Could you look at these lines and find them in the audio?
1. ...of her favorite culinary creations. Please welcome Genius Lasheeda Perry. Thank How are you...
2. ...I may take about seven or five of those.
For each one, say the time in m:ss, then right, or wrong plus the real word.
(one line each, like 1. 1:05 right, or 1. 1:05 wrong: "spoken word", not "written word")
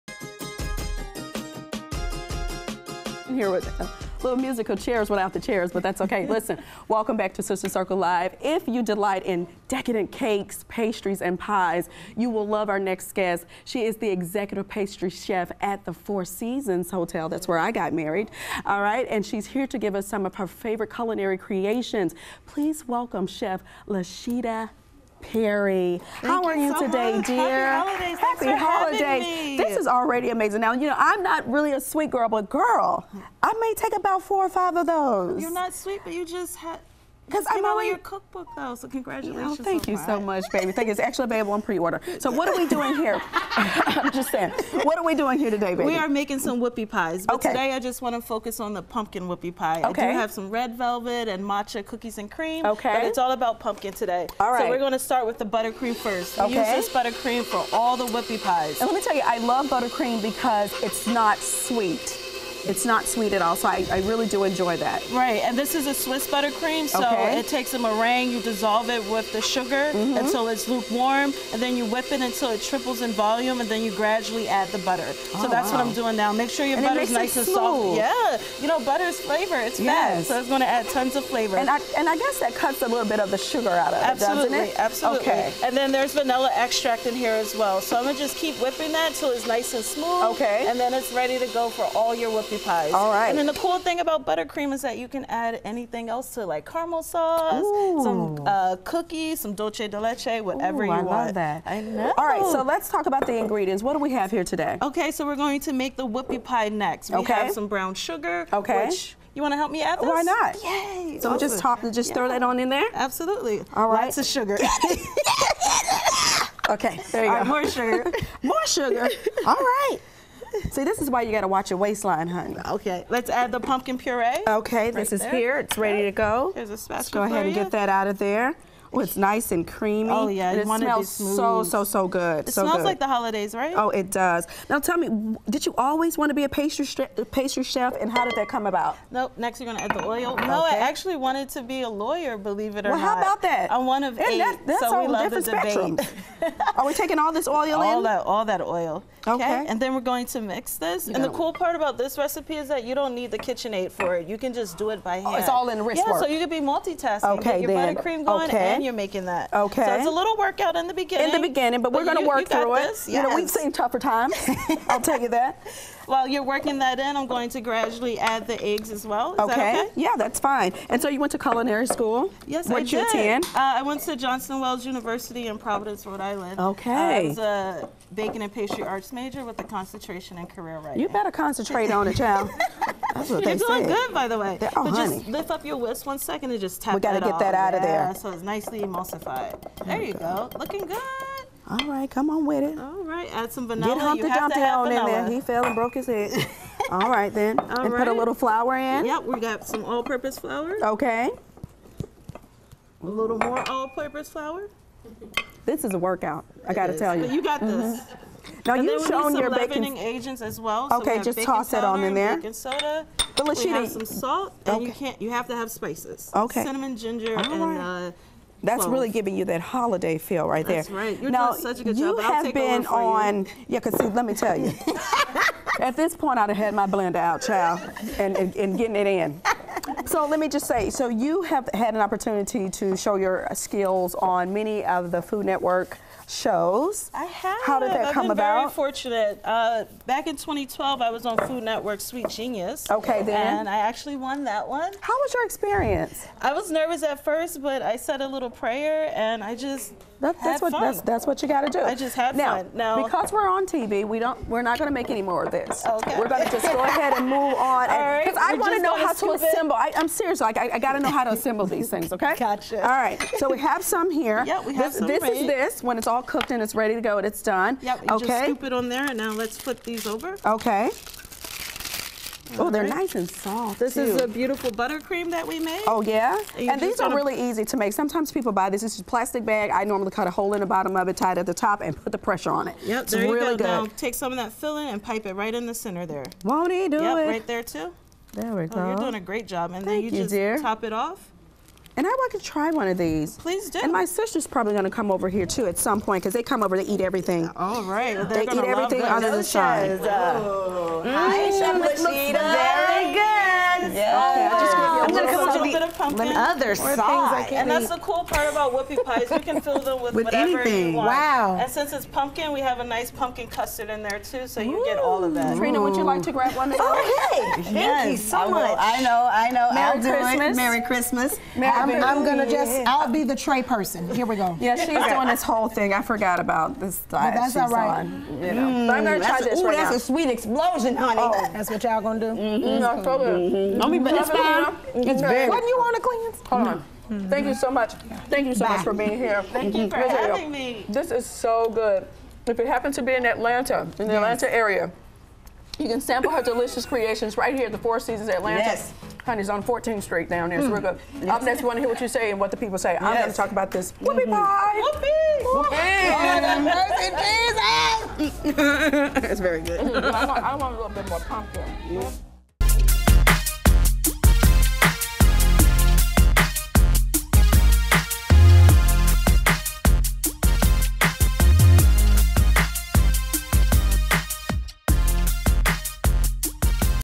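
1. 0:20 wrong: "Chef", not "Genius"
2. 0:33 wrong: "four", not "seven".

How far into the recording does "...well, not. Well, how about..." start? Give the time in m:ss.
2:22.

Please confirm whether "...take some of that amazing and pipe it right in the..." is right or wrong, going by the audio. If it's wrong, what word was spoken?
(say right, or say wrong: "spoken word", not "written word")
wrong: "filling", not "amazing".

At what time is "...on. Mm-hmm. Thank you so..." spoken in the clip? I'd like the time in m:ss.
5:36.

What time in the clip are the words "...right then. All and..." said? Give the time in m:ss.
3:17.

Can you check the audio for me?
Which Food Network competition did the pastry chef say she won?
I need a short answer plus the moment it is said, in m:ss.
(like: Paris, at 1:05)
Sweet Genius, at 4:01.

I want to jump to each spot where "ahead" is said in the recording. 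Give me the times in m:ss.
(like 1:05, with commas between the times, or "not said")
2:07, 4:16.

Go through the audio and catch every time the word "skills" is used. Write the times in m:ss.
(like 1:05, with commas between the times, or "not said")
3:53.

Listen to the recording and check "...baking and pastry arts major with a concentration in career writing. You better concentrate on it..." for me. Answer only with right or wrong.
right.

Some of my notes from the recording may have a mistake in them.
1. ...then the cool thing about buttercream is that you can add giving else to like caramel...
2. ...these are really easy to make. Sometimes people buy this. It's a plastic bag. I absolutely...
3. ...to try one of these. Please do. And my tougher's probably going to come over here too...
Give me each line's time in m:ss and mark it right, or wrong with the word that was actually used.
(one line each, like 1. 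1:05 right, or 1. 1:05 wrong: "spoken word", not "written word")
1. 1:33 wrong: "anything", not "giving"
2. 4:36 wrong: "normally", not "absolutely"
3. 4:52 wrong: "sister", not "tougher".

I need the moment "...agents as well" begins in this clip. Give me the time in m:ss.
3:29.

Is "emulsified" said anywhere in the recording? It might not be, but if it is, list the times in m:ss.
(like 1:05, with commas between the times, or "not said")
3:08.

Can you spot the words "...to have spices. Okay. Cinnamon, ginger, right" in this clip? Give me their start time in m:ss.
3:35.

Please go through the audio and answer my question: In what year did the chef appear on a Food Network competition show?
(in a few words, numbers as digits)
2012.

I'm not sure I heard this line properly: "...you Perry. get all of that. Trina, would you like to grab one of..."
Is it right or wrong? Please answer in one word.
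wrong.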